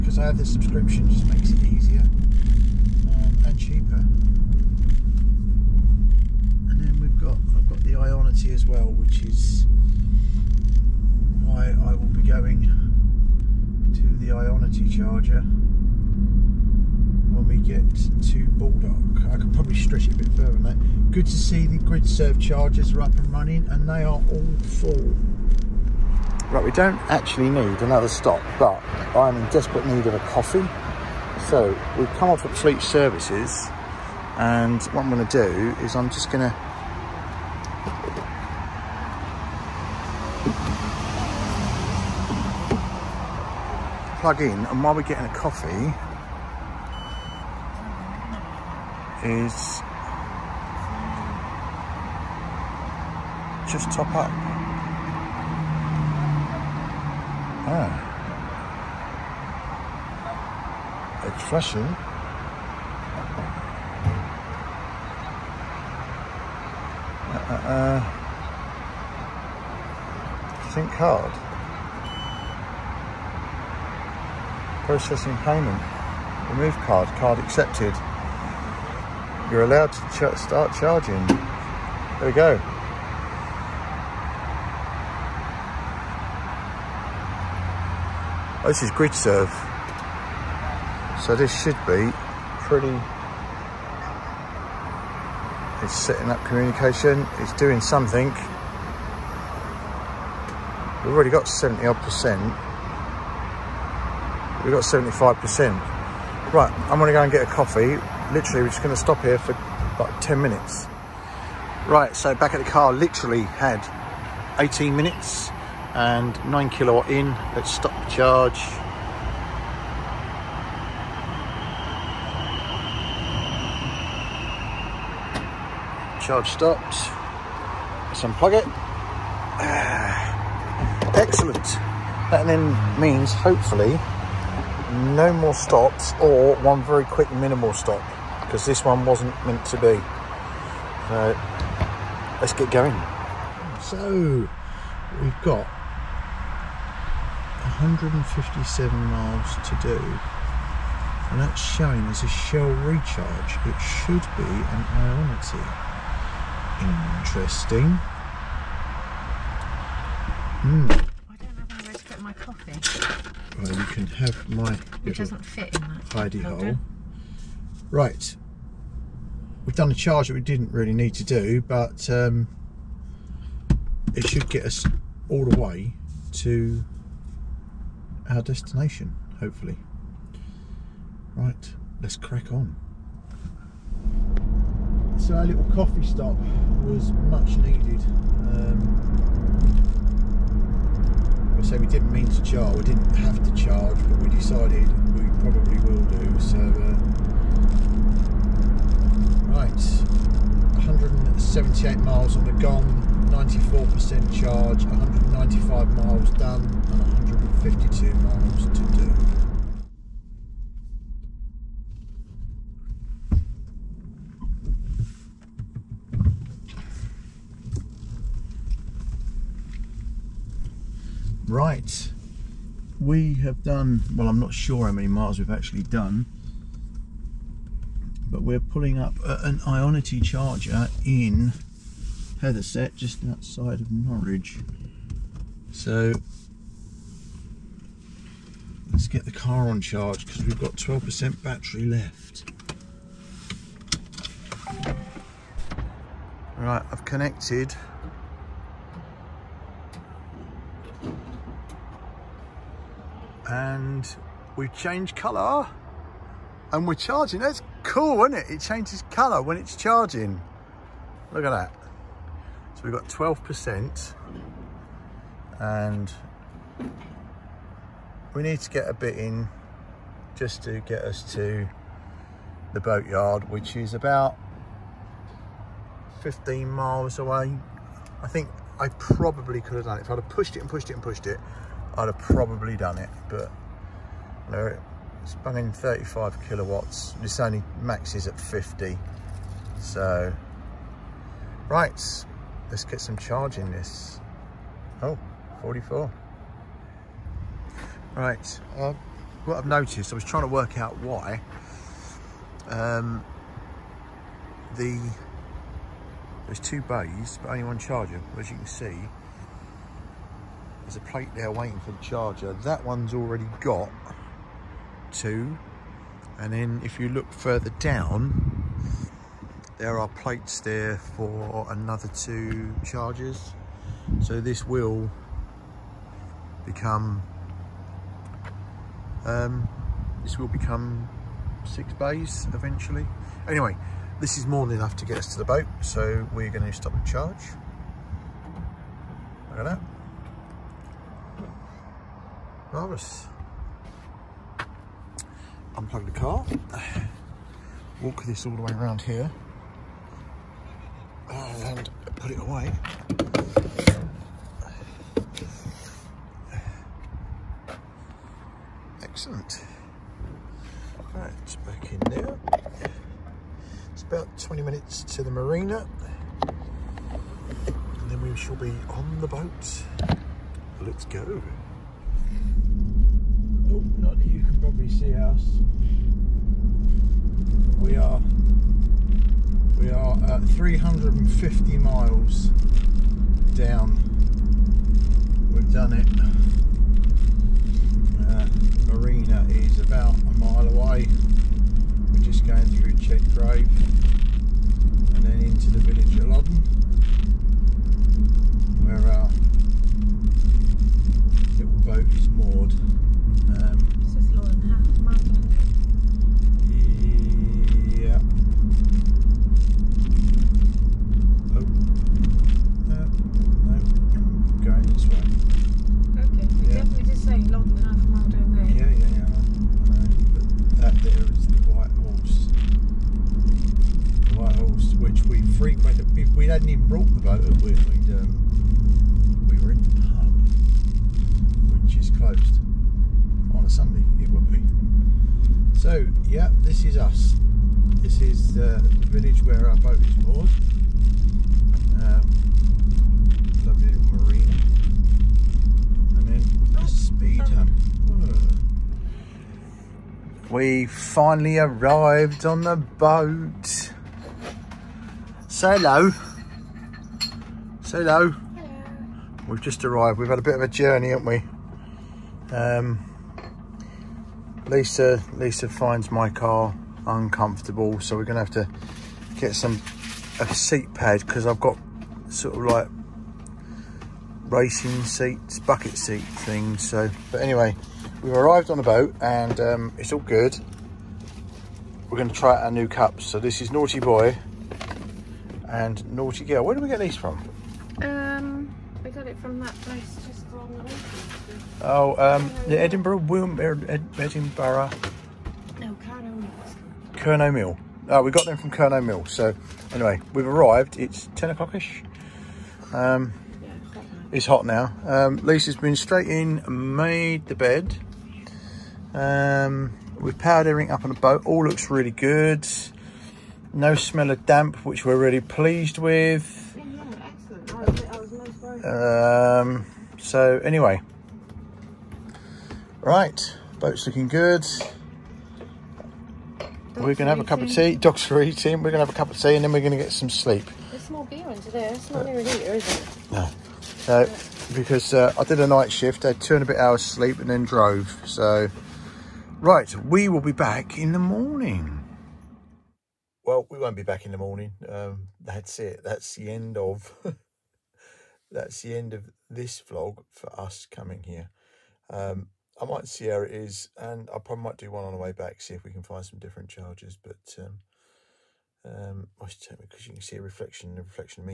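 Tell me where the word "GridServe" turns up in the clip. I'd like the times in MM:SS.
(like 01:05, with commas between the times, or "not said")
00:21, 01:28.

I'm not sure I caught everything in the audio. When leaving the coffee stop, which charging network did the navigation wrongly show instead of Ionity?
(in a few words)
Shell Recharge.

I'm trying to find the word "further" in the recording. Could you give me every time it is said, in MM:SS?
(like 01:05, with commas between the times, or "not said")
00:20, 05:17.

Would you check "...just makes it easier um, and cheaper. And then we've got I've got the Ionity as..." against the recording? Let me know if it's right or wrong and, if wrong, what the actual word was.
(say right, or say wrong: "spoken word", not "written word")
right.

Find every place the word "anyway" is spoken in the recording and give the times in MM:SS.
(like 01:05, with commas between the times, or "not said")
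05:33, 07:57, 08:19, 08:40.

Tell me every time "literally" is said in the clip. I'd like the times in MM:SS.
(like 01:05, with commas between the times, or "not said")
01:48, 01:52.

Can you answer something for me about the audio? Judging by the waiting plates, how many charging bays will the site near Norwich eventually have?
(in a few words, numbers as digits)
6.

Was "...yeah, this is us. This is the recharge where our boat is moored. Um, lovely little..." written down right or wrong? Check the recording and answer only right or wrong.
wrong.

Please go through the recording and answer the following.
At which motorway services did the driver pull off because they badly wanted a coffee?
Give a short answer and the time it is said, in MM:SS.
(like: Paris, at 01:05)
Fleet Services, at 00:32.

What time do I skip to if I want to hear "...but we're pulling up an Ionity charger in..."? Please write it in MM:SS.
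03:48.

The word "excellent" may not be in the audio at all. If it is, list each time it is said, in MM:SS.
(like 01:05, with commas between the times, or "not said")
02:11, 05:59.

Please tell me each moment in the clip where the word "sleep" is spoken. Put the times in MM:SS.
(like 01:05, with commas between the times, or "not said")
08:50, 08:57.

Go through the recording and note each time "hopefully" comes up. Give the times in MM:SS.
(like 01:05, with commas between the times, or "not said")
02:13, 02:59.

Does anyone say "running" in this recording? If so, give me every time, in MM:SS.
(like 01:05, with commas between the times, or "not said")
00:23, 04:45.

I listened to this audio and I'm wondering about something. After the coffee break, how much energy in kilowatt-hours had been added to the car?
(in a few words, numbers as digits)
9.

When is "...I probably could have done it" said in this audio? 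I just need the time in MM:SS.
04:38.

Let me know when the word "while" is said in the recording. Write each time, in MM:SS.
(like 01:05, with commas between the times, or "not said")
00:44.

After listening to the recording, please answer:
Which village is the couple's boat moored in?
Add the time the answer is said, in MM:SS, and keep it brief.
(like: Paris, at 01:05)
Loddon, at 06:36.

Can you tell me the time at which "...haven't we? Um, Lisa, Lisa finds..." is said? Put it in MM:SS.
07:41.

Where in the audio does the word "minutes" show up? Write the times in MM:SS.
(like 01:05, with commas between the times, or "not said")
01:50, 01:54, 06:04.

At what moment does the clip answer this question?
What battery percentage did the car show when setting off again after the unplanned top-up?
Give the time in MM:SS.
03:23.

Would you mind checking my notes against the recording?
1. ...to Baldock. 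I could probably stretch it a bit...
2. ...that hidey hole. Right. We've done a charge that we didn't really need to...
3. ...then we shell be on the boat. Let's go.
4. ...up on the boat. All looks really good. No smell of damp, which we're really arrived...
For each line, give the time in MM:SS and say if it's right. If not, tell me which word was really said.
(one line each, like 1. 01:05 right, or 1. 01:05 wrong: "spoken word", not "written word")
1. 00:18 right
2. 02:45 right
3. 06:08 wrong: "shall", not "shell"
4. 08:30 wrong: "pleased", not "arrived".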